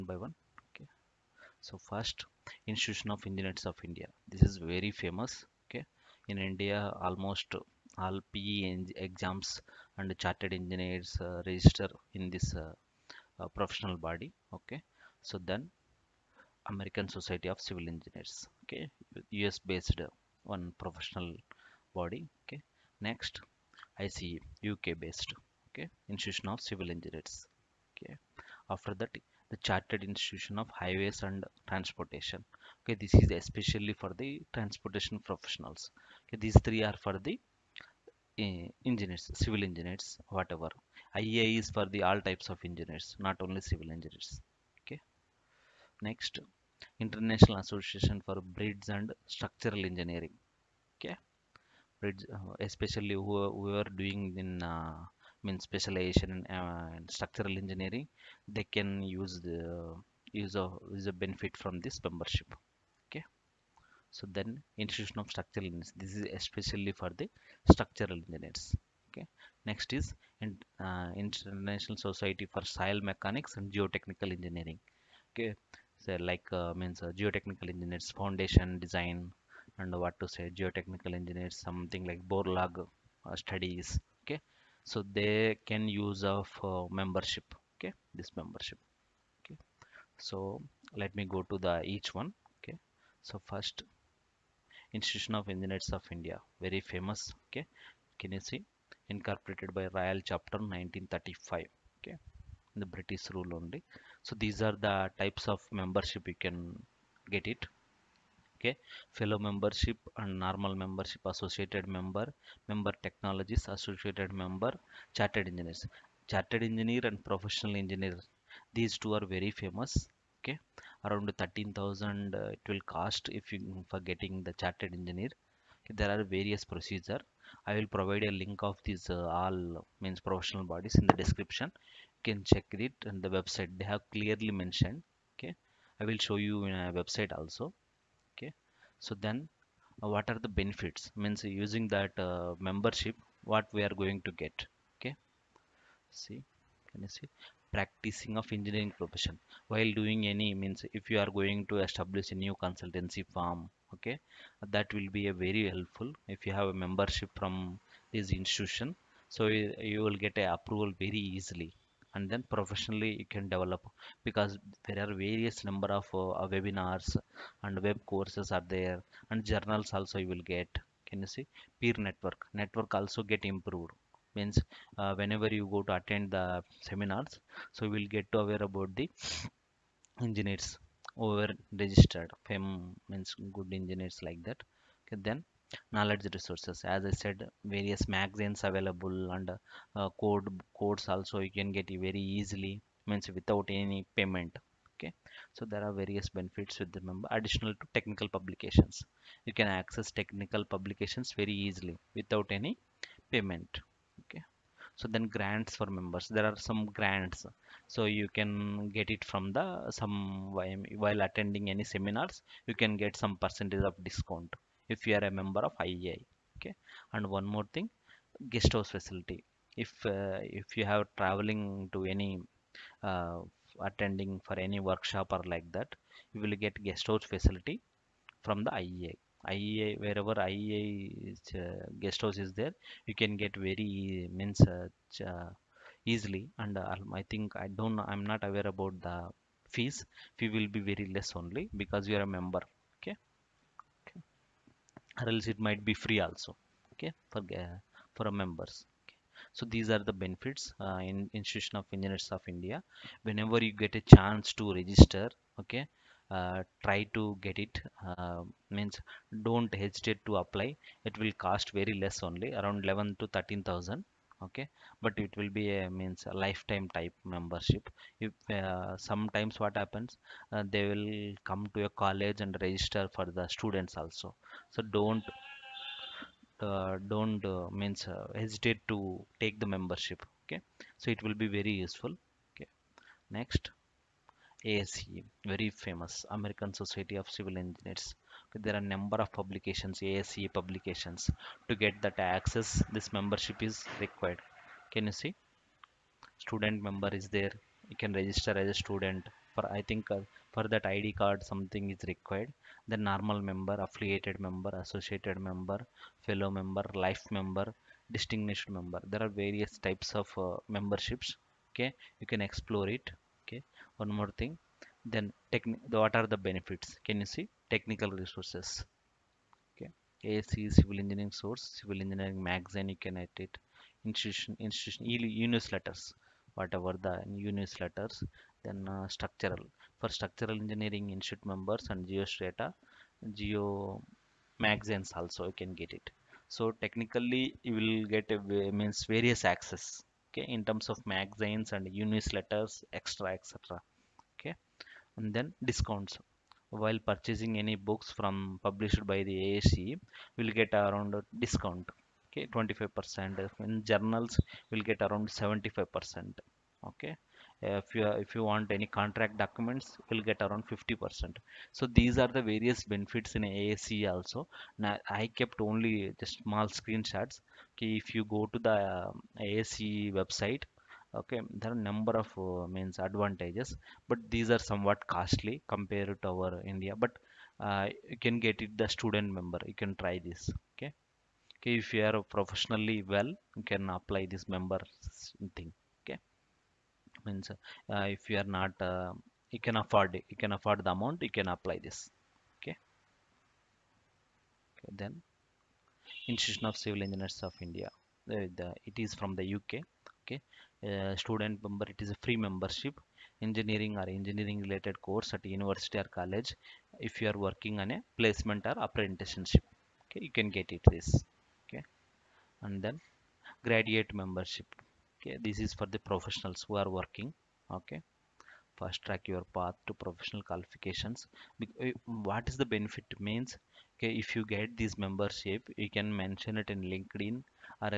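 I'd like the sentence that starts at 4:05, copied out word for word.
or else it might be free also okay for uh, for a members okay.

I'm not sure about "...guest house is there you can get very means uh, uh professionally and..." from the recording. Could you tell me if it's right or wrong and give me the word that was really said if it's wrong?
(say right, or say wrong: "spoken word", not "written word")
wrong: "easily", not "professionally".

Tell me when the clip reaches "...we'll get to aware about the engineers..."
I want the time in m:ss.
2:57.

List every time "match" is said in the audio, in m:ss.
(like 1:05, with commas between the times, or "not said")
not said.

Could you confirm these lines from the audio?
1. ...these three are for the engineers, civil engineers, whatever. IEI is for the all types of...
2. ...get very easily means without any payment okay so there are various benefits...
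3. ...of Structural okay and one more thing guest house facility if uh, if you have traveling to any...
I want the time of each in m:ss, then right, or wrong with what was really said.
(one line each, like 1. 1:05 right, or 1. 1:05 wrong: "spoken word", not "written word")
1. 0:36 right
2. 3:11 right
3. 3:35 wrong: "IEI", not "Structural".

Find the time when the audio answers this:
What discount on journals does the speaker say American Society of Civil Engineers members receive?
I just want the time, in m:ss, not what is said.
5:55.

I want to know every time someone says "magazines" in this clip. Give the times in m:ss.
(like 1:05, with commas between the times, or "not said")
3:08, 5:22, 5:34, 5:41.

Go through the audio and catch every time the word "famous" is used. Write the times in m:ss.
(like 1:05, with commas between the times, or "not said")
0:04, 1:36, 1:59, 4:45.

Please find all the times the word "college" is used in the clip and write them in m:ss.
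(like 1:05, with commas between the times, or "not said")
4:32, 6:46.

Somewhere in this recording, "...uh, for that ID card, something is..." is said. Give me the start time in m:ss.
5:00.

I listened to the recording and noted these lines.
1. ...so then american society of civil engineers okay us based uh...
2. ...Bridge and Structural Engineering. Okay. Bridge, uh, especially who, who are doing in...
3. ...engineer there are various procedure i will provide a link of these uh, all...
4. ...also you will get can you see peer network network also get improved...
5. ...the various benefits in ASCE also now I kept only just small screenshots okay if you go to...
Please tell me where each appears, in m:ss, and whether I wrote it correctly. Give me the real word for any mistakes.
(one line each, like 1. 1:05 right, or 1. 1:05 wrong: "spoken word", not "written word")
1. 0:15 right
2. 0:48 right
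3. 2:04 right
4. 2:49 right
5. 6:02 right.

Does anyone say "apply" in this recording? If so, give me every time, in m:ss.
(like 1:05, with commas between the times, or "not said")
4:20, 6:23, 6:31.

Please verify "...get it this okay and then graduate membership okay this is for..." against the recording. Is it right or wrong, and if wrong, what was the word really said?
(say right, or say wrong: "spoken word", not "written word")
right.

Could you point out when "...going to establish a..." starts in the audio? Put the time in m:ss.
2:31.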